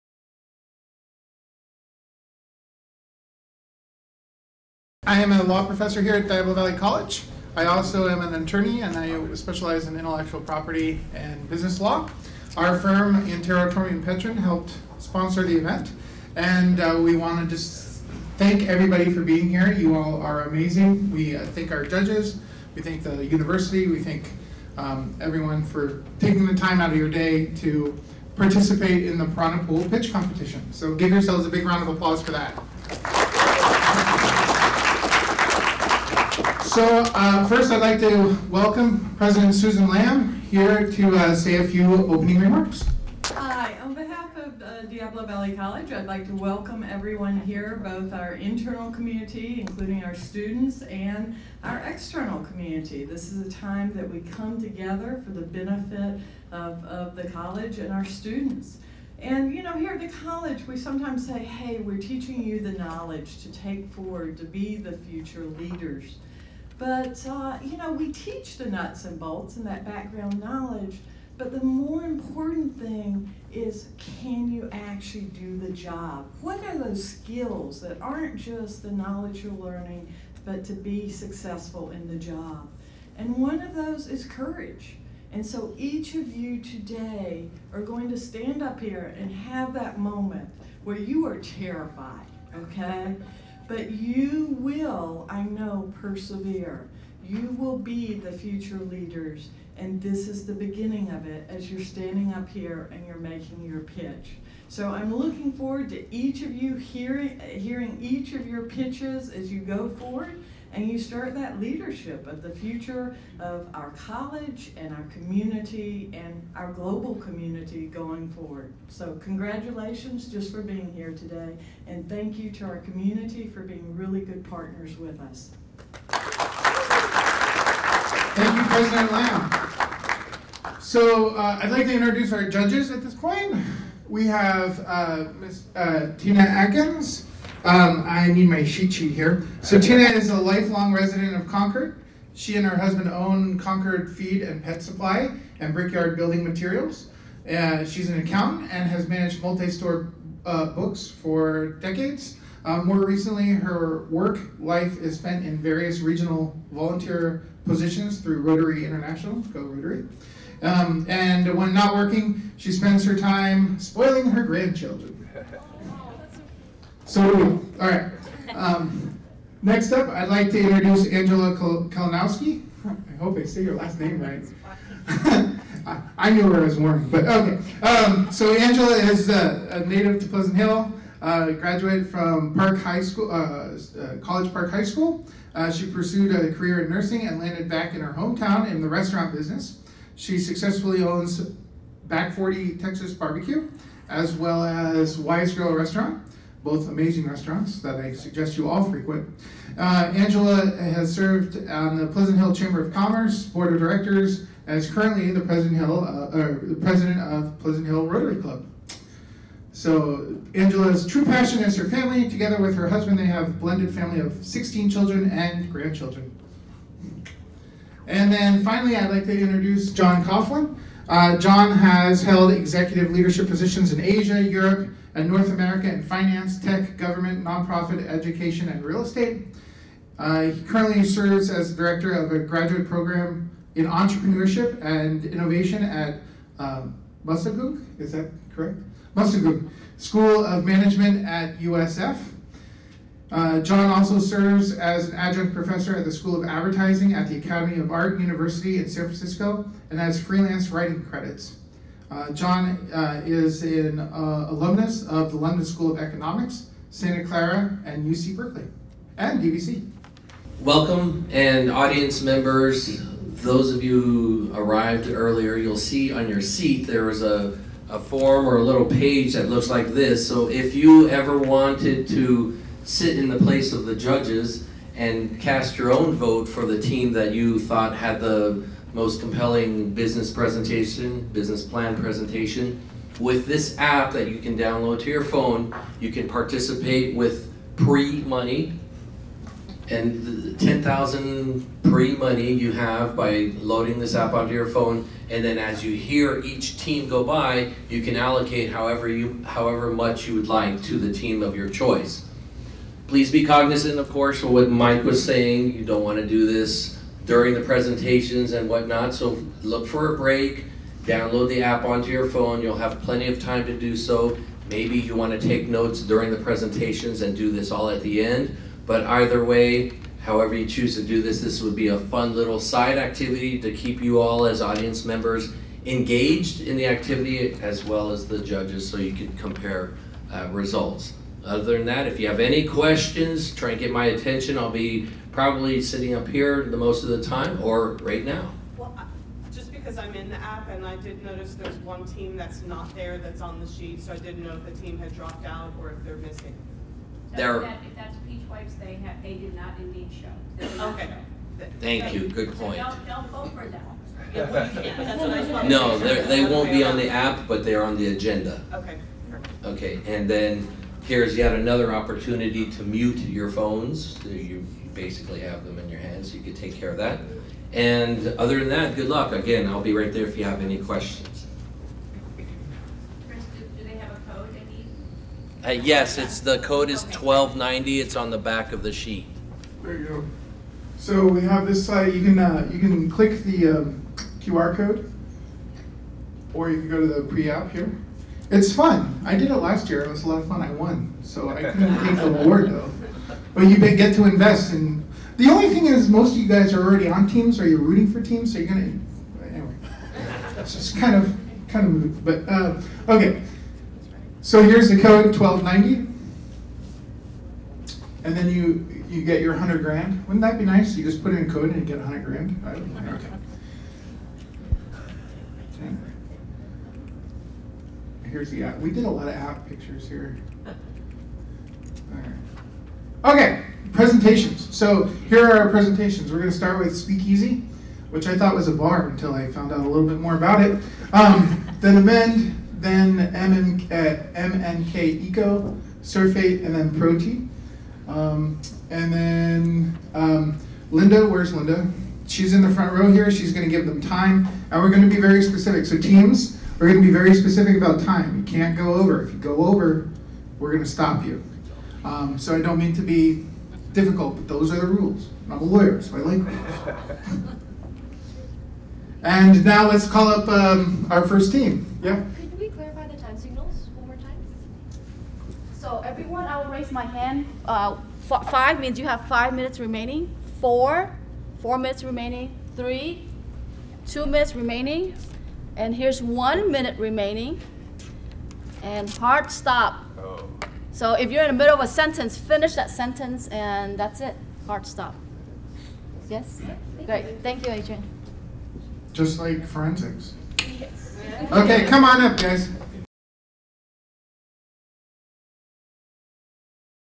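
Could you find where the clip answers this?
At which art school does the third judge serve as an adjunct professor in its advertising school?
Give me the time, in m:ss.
4:07.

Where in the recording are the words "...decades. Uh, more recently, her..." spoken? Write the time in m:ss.
2:31.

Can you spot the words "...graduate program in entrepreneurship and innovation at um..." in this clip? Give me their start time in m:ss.
3:52.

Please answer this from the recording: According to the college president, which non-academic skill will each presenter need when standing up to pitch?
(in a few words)
Courage.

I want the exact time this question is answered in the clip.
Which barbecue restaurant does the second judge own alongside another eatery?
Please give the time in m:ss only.
3:12.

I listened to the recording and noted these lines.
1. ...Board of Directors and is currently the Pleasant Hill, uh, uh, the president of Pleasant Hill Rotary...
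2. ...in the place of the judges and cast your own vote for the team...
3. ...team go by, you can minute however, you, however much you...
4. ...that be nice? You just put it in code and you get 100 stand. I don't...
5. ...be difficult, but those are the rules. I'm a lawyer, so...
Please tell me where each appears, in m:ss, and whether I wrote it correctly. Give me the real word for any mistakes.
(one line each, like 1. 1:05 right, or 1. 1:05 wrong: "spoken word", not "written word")
1. 3:23 right
2. 4:33 right
3. 4:56 wrong: "allocate", not "minute"
4. 6:50 wrong: "grand", not "stand"
5. 7:33 right.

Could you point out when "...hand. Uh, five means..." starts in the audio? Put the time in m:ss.
7:47.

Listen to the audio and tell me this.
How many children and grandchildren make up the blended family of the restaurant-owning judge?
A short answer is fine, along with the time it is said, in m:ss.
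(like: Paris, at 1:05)
16, at 3:34.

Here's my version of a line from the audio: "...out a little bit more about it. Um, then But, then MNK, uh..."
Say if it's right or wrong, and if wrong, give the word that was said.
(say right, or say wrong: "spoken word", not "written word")
wrong: "Amend", not "But".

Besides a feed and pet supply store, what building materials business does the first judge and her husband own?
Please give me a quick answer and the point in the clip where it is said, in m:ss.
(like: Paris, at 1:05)
Brickyard Building Materials, at 2:25.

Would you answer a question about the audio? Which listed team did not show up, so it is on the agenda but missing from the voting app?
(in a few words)
Peach Wipes.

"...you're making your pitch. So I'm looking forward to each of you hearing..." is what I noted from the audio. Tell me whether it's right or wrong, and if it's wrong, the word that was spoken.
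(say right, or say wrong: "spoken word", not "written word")
right.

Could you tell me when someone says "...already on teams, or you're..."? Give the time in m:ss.
6:36.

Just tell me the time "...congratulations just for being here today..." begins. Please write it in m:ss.
1:59.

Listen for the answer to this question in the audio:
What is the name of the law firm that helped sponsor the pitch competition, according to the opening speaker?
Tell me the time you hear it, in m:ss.
0:13.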